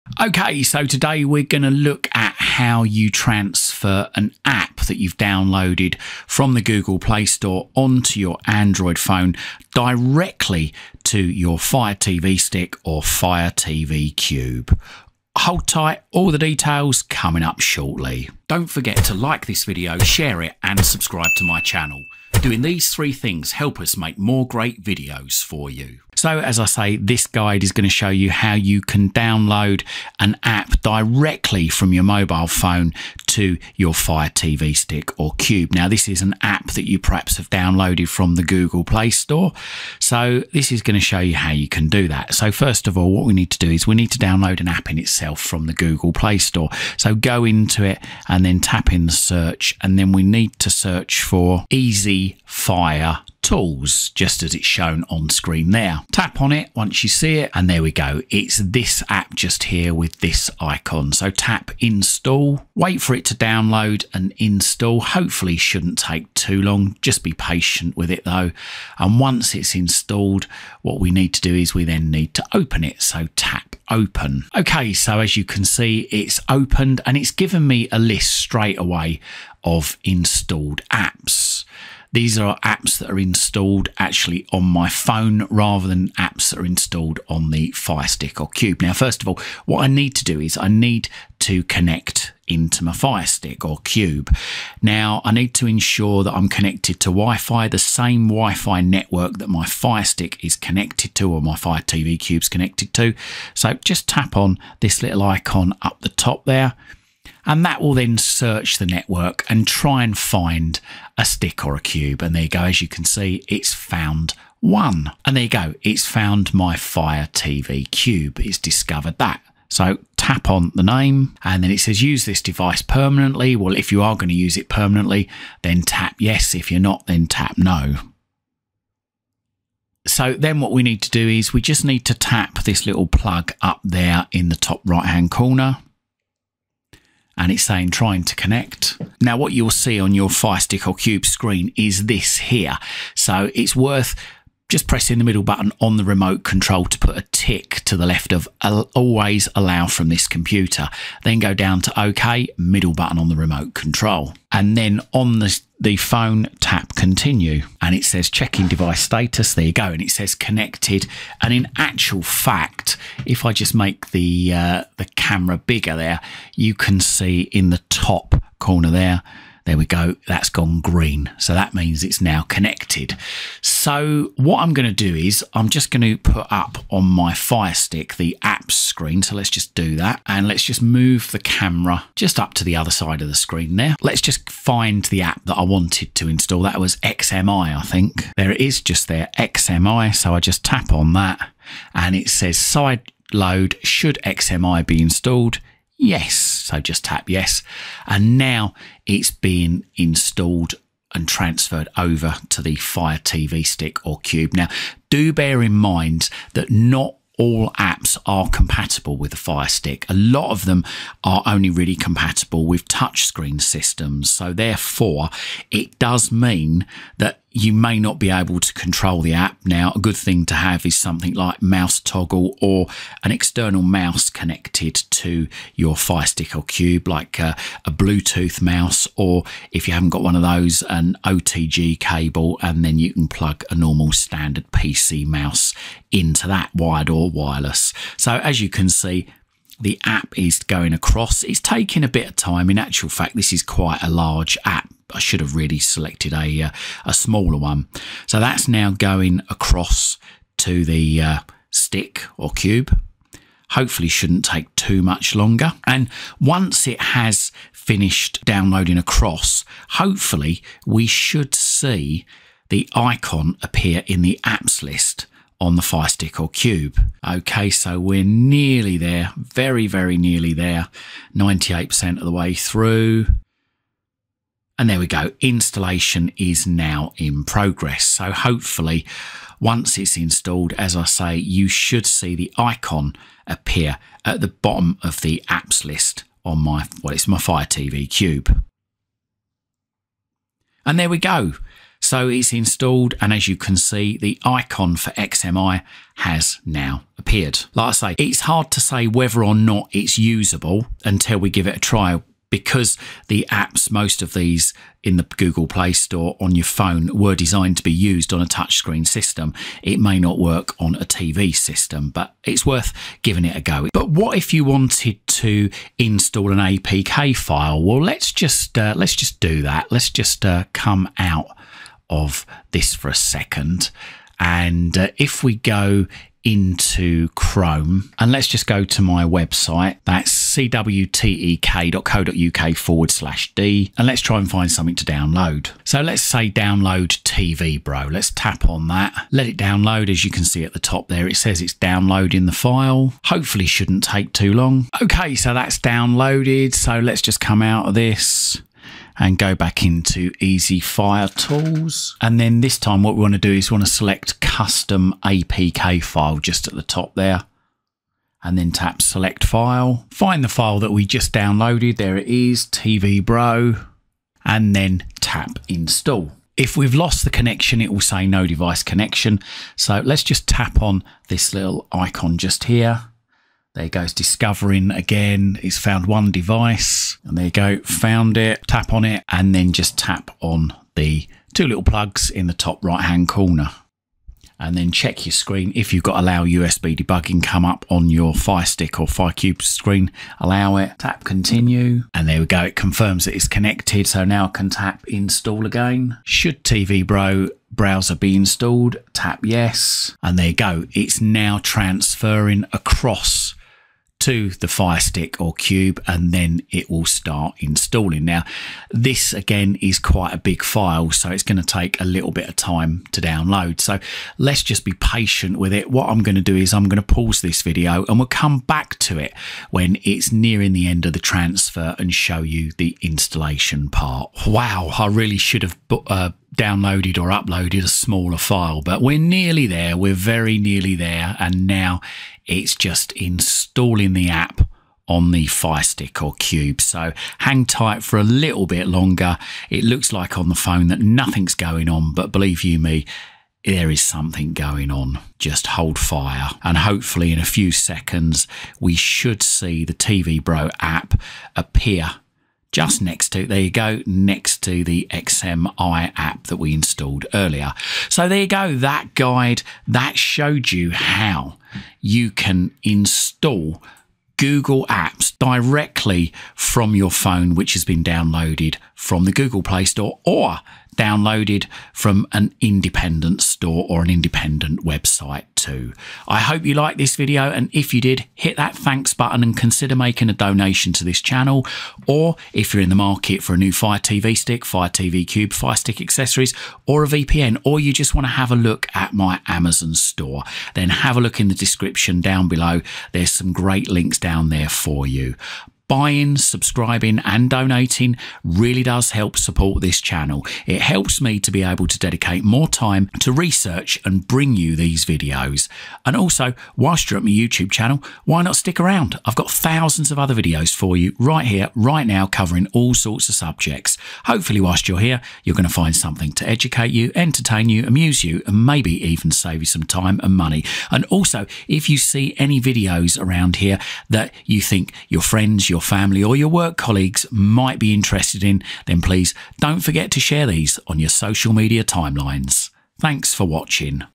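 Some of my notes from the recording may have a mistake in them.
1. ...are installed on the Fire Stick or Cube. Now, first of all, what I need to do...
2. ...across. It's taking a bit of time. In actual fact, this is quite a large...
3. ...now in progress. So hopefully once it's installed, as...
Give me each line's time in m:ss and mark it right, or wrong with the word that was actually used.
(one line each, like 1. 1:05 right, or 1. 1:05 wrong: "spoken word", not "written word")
1. 1:26 right
2. 4:00 right
3. 4:36 right.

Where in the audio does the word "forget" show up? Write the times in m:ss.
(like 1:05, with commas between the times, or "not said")
0:18, 8:49.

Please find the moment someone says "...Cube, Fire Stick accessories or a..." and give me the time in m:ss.
8:05.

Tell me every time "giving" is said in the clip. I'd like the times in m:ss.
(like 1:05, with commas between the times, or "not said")
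5:13.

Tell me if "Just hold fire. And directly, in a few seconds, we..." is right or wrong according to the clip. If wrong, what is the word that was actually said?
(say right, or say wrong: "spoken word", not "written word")
wrong: "hopefully", not "directly".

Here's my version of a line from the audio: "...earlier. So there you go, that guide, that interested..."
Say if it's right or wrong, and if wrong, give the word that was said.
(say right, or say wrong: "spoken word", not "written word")
wrong: "showed", not "interested".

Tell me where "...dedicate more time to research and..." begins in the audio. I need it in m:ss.
8:21.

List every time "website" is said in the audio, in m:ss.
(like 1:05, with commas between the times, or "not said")
5:29, 7:54.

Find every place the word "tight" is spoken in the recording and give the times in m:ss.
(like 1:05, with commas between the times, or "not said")
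0:15, 7:17.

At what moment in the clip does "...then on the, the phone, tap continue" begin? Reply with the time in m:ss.
2:34.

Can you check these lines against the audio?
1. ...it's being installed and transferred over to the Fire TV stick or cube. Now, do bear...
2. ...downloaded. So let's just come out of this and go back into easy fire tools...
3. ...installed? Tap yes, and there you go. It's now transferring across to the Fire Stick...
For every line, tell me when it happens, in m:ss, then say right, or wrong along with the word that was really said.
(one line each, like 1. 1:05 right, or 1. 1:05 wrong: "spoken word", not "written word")
1. 3:19 right
2. 5:45 right
3. 6:38 right.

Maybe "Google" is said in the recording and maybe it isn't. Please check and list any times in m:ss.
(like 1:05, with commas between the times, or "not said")
0:06, 0:38, 0:45, 5:05, 7:44, 7:49.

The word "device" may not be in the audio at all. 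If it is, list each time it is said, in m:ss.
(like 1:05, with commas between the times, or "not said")
2:02, 2:38, 6:08, 6:16.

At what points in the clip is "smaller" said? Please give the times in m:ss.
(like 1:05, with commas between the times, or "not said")
4:07, 7:07.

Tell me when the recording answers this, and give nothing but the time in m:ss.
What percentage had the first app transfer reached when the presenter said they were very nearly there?
4:31.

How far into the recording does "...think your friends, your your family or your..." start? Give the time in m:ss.
8:44.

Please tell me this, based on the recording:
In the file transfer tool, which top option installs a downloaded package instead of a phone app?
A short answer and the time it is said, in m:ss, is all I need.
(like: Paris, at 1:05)
custom apk file, at 5:54.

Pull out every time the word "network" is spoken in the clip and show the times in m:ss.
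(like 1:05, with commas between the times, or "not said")
1:38, 1:48.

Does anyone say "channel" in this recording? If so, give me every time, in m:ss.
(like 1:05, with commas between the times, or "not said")
0:21, 8:01, 8:19, 8:27.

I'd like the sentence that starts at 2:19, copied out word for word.
Now, what you'll see on your Fire Stick or Cube screen is this here.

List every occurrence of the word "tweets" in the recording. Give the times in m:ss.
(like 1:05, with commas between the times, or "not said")
not said.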